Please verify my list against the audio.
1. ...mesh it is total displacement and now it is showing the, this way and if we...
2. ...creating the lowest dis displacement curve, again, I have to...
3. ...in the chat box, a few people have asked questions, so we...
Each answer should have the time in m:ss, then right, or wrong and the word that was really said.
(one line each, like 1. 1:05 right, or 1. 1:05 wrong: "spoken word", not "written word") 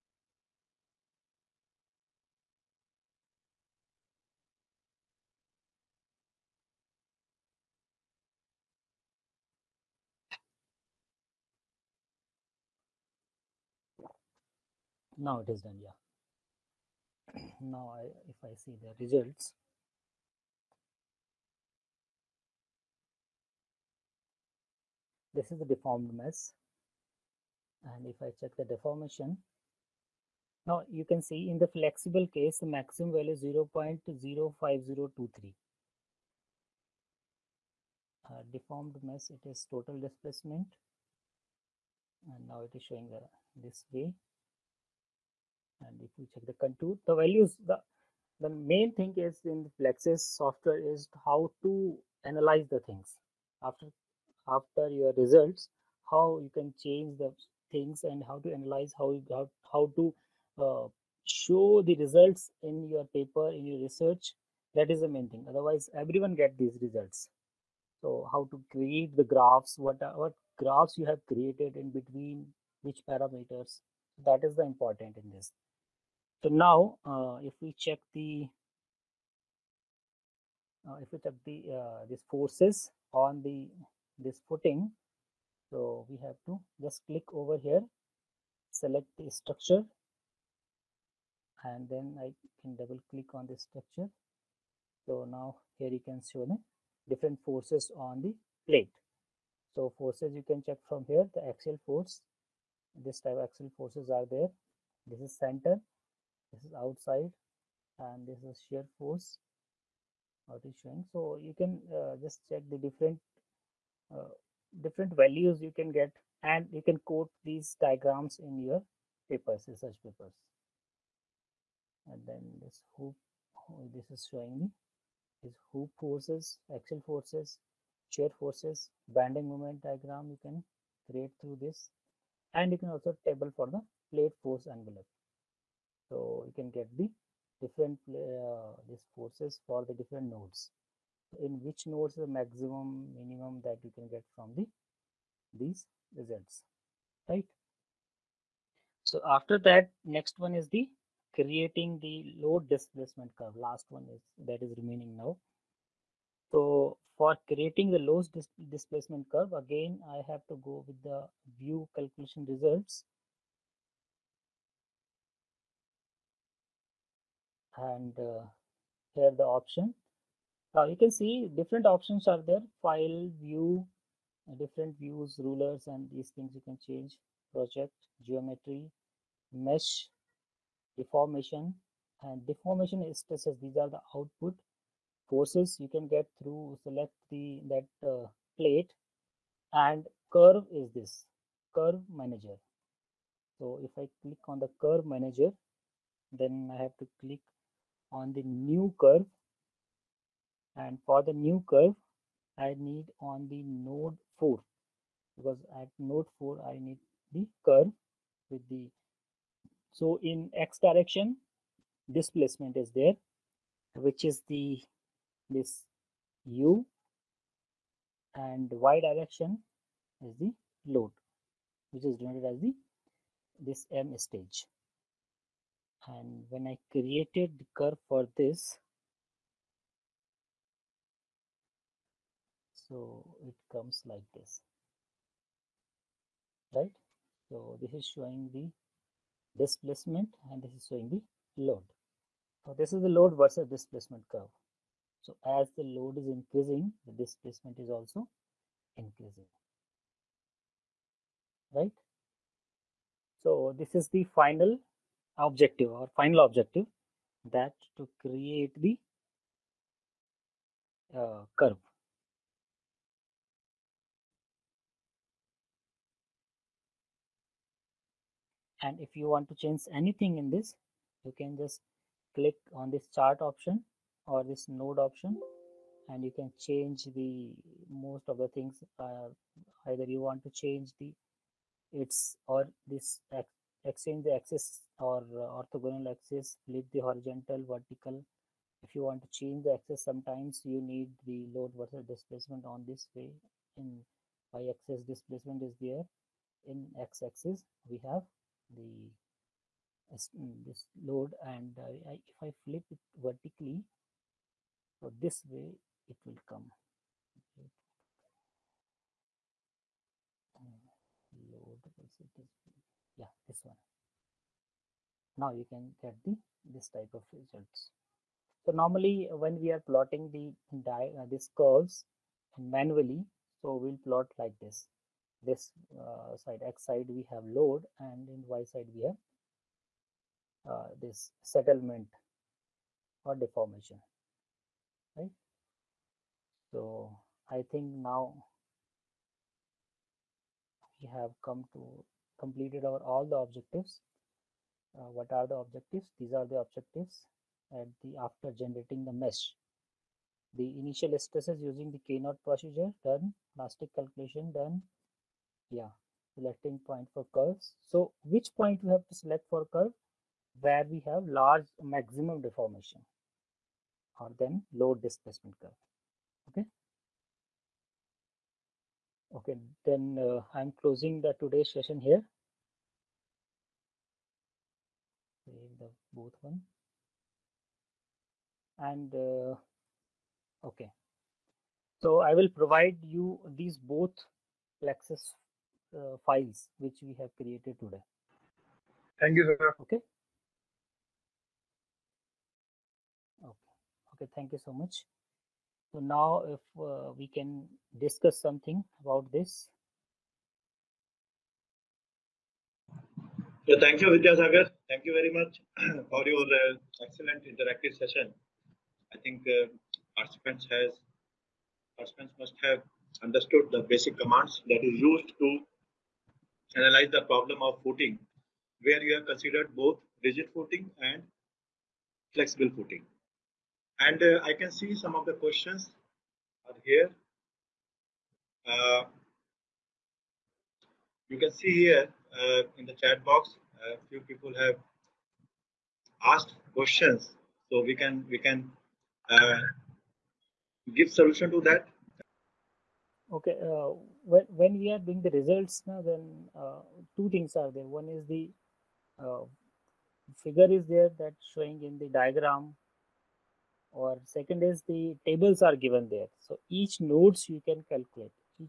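1. 0:39 right
2. 2:37 right
3. 7:12 right.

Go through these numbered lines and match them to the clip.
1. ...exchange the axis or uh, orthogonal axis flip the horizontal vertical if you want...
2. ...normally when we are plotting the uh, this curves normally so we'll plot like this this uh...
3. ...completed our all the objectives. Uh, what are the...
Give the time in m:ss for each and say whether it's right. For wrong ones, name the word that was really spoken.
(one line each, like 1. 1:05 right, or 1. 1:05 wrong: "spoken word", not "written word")
1. 4:43 right
2. 5:18 wrong: "manually", not "normally"
3. 5:42 right.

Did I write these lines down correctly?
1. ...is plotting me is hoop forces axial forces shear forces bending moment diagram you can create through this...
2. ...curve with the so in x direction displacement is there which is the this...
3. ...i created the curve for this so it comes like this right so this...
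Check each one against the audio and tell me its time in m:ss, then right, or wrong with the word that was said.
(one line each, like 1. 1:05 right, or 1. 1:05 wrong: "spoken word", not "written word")
1. 2:04 wrong: "showing", not "plotting"
2. 3:27 right
3. 3:46 right.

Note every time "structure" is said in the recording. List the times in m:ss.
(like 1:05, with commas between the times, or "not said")
1:29, 1:33.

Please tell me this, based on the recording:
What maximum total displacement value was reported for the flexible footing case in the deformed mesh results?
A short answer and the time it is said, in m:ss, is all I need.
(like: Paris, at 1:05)
0.05023, at 0:33.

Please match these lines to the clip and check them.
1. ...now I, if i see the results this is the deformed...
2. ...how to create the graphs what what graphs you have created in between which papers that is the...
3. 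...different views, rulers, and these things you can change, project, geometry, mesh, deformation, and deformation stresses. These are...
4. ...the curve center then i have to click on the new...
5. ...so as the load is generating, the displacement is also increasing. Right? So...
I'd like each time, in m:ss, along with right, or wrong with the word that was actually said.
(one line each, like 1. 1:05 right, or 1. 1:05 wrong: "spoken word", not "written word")
1. 0:17 right
2. 1:08 wrong: "parameters", not "papers"
3. 2:54 right
4. 3:14 wrong: "manager", not "center"
5. 4:05 wrong: "increasing", not "generating".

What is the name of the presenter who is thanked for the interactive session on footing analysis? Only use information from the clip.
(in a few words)
Sagar.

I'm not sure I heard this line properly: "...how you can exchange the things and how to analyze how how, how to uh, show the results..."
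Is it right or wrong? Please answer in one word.
wrong.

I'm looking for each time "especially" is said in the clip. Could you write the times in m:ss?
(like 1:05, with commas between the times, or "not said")
not said.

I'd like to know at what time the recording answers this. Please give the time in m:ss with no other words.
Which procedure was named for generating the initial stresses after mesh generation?
5:52.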